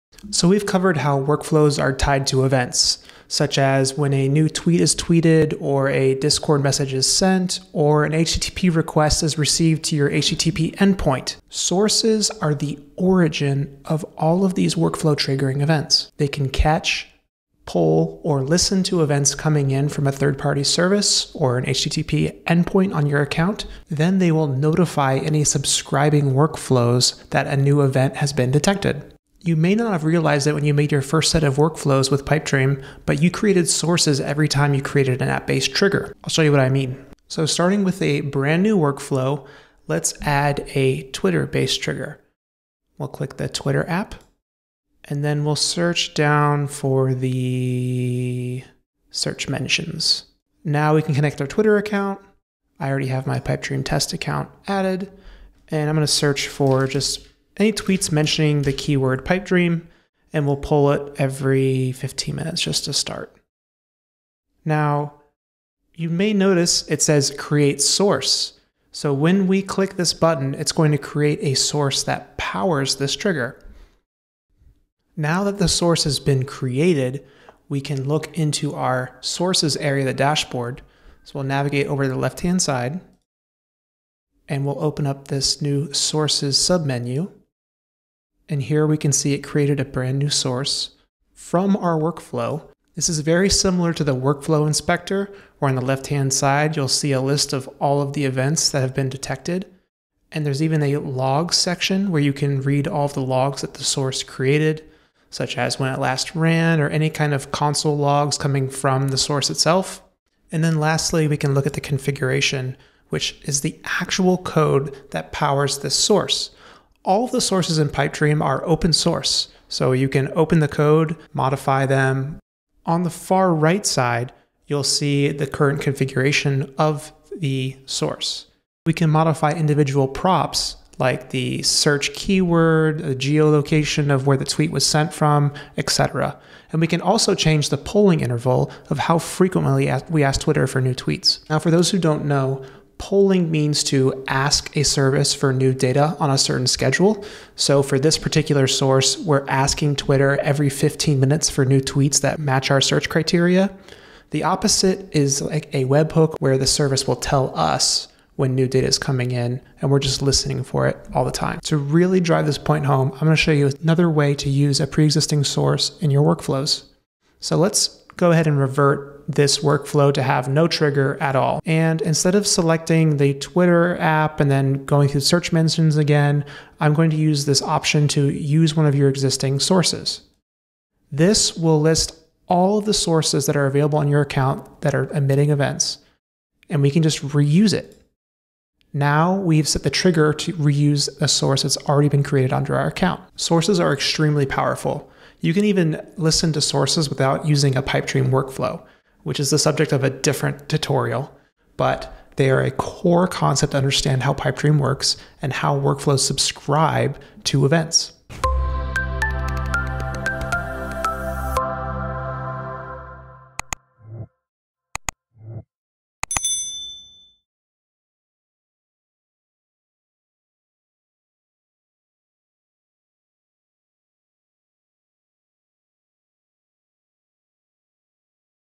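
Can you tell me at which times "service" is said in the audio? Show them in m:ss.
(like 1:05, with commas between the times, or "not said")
0:20, 2:24, 2:36.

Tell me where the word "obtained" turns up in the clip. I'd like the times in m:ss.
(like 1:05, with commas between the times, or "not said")
not said.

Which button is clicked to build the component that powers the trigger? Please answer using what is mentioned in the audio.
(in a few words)
create source.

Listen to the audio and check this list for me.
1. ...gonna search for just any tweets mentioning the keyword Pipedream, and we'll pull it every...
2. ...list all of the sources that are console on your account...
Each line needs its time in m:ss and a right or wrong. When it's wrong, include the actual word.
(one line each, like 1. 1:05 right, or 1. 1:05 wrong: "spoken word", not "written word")
1. 0:55 right
2. 3:01 wrong: "available", not "console".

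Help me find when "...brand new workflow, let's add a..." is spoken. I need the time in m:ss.
0:38.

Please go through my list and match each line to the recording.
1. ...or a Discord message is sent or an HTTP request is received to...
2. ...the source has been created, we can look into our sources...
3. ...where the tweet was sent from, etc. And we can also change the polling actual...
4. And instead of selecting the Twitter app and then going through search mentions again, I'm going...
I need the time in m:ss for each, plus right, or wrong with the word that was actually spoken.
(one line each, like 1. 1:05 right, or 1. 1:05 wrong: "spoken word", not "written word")
1. 0:05 right
2. 1:15 right
3. 2:14 wrong: "interval", not "actual"
4. 2:51 right.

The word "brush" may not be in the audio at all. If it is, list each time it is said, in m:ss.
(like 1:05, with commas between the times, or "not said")
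not said.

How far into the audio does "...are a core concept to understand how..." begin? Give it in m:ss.
3:22.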